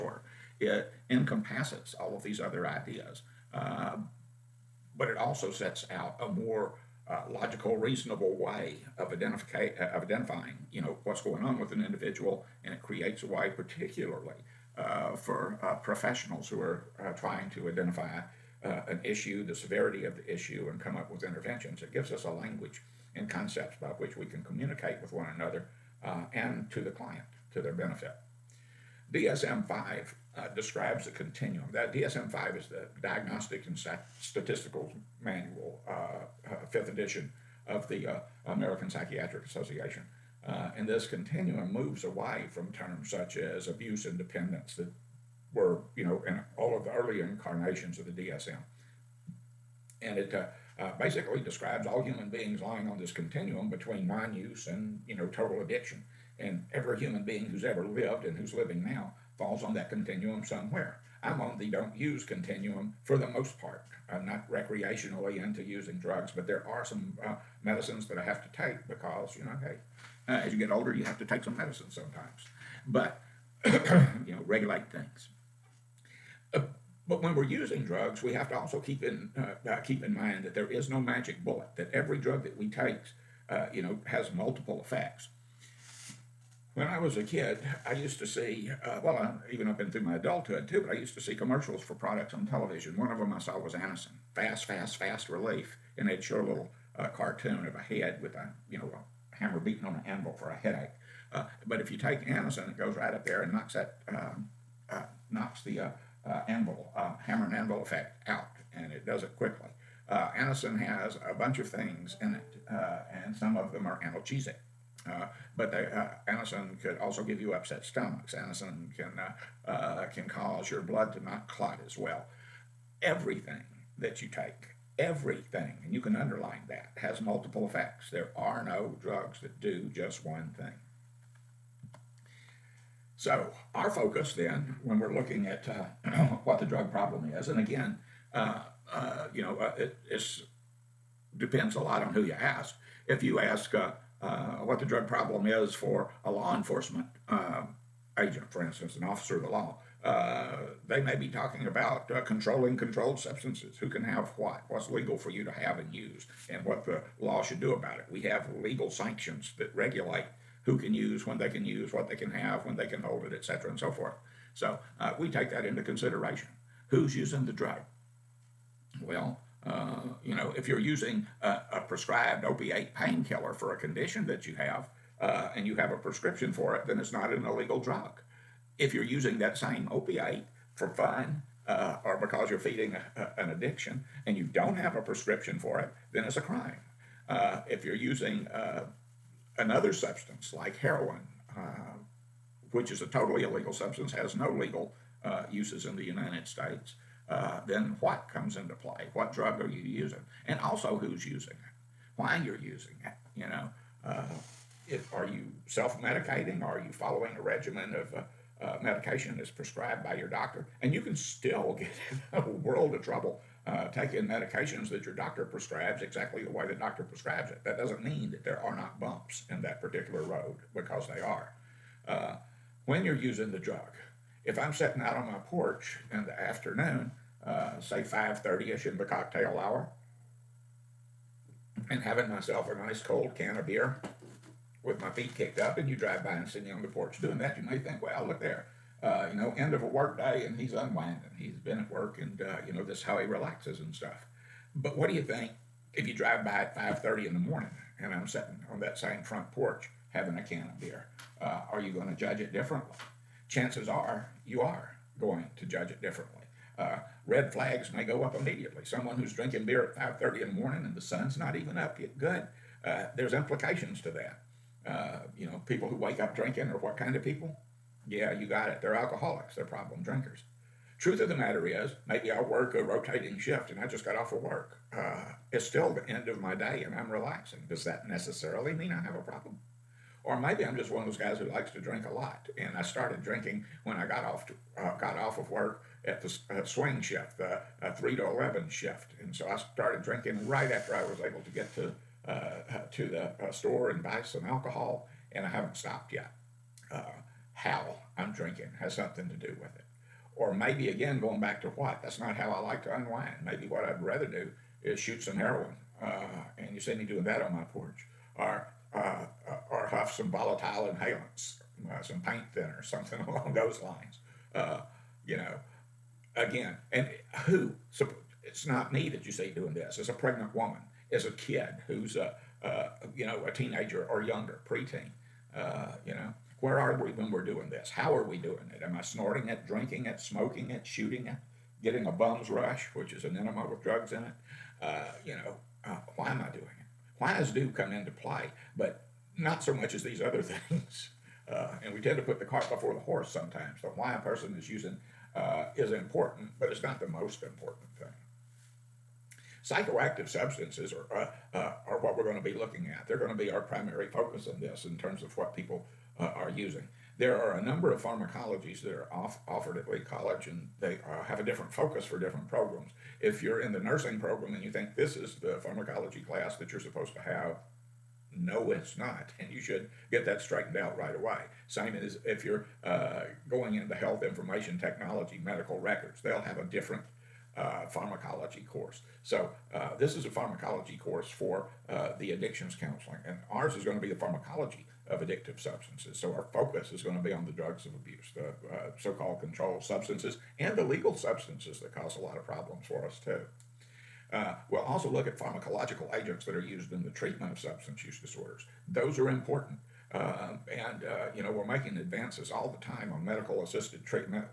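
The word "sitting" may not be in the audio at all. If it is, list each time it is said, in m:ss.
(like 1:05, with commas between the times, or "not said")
3:44, 4:08.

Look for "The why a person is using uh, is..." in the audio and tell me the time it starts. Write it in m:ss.
5:43.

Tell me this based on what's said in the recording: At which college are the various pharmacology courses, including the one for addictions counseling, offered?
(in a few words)
Lee College.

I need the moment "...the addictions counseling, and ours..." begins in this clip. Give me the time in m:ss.
6:22.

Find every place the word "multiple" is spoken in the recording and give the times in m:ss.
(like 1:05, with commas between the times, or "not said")
1:24, 2:07.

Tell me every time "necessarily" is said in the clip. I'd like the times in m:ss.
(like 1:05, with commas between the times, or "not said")
4:38.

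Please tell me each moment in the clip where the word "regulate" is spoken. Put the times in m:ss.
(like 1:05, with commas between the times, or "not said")
1:14, 2:39.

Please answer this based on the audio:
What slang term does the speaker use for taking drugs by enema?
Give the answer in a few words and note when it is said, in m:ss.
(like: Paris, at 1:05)
bum's rush, at 5:32.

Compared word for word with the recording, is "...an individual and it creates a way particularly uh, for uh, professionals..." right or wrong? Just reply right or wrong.
right.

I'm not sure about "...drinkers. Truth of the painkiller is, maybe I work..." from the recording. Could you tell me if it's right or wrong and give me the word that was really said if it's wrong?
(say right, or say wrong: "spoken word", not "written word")
wrong: "matter", not "painkiller".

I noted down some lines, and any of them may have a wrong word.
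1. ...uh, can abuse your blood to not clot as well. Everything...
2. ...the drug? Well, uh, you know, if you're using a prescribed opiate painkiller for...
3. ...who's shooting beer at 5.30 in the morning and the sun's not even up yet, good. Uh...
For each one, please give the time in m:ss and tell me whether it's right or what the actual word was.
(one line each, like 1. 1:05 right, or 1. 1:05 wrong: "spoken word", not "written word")
1. 1:59 wrong: "cause", not "abuse"
2. 2:47 right
3. 4:19 wrong: "drinking", not "shooting".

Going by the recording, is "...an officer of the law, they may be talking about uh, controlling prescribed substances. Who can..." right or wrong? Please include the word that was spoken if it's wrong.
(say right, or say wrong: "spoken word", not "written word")
wrong: "controlled", not "prescribed".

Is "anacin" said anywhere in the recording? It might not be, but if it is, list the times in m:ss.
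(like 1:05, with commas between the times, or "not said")
1:33, 1:42, 1:50, 1:58.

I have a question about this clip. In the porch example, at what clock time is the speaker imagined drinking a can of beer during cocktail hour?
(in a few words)
5:30.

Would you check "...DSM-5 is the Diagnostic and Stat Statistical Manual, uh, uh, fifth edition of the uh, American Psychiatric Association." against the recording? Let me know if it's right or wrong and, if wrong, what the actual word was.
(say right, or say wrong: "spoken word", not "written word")
right.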